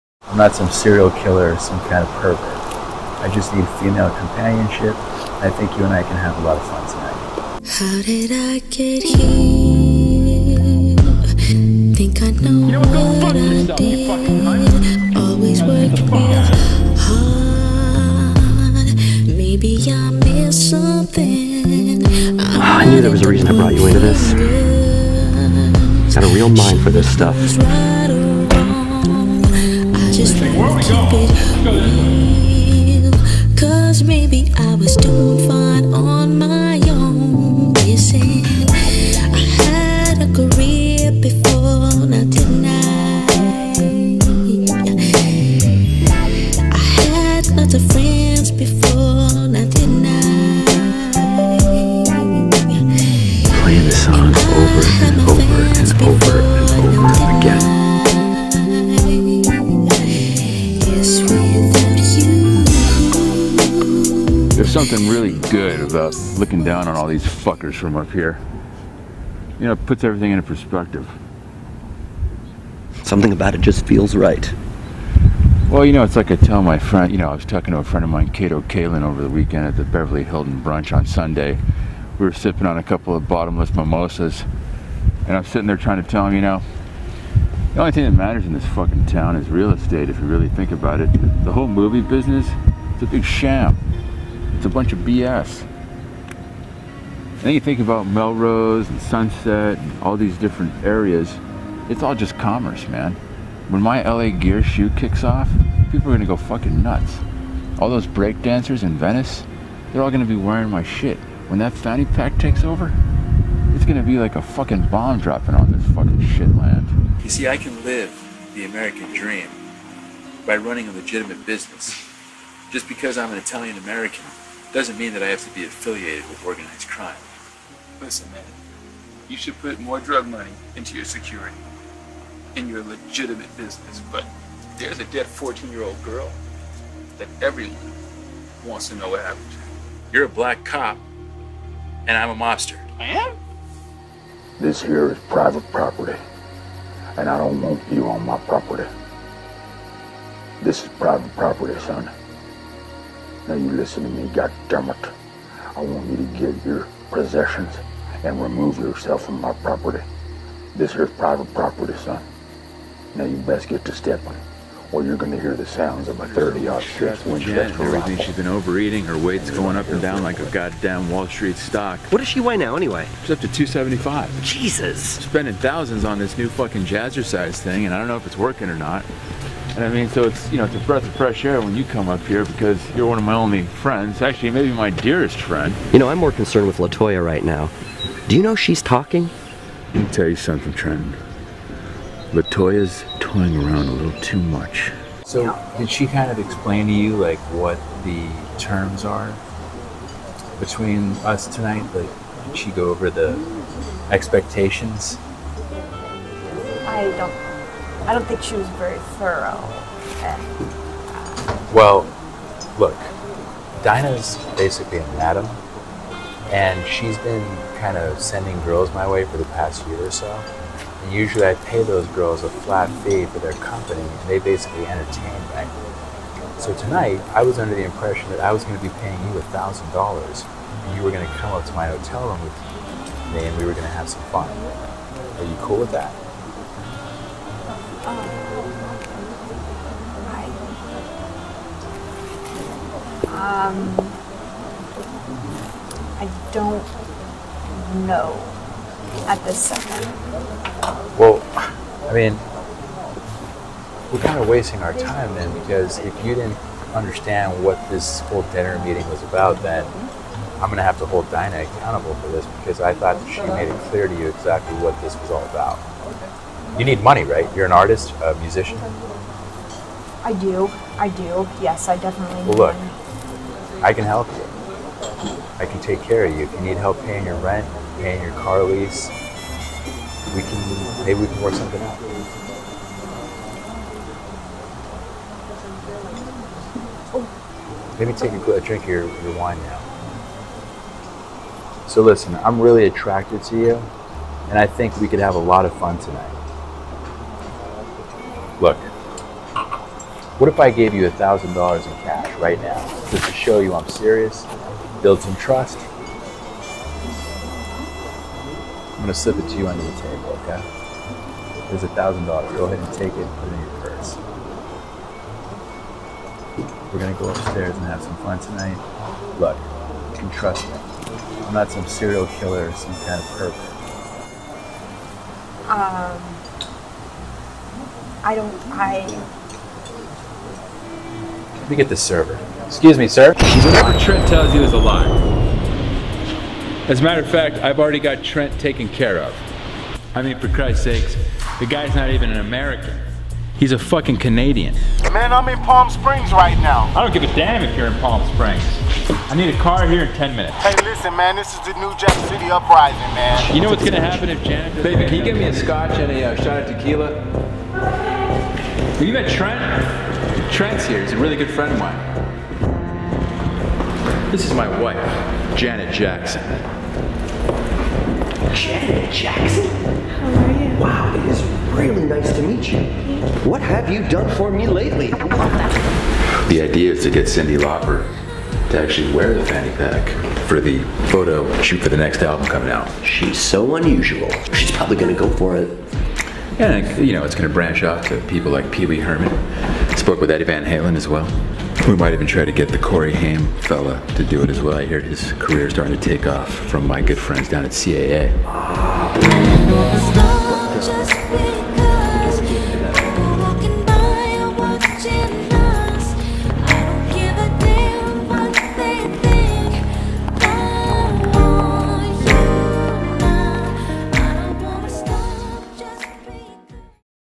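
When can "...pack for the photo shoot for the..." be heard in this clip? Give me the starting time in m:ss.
6:19.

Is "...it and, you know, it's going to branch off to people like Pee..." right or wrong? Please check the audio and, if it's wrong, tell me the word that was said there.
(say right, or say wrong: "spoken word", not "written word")
right.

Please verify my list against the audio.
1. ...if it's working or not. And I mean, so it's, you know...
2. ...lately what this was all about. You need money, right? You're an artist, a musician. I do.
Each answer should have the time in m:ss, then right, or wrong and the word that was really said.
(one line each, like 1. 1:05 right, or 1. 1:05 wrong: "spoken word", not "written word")
1. 2:58 right
2. 4:24 wrong: "exactly", not "lately".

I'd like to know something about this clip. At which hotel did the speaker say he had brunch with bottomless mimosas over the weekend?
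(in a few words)
Beverly Hilton.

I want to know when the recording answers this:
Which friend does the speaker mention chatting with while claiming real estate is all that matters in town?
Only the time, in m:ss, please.
1:18.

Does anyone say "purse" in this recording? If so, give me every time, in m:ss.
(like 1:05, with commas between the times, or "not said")
5:13.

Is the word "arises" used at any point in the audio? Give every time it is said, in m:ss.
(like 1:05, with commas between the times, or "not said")
not said.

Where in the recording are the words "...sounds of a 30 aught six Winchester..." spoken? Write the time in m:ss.
2:45.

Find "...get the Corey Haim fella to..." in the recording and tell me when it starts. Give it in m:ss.
6:32.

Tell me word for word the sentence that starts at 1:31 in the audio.
The whole movie business, it's a big sham.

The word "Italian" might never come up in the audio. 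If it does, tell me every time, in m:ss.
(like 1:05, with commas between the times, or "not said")
2:03.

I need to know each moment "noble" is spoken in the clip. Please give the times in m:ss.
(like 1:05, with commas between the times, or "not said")
not said.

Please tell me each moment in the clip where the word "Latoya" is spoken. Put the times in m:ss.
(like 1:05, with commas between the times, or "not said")
3:06, 3:12.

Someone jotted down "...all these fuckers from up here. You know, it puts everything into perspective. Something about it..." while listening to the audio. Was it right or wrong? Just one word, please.
right.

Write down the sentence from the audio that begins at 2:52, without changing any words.
What does she weigh now anyway?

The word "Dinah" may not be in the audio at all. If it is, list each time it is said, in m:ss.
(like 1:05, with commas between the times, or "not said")
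3:33, 4:21.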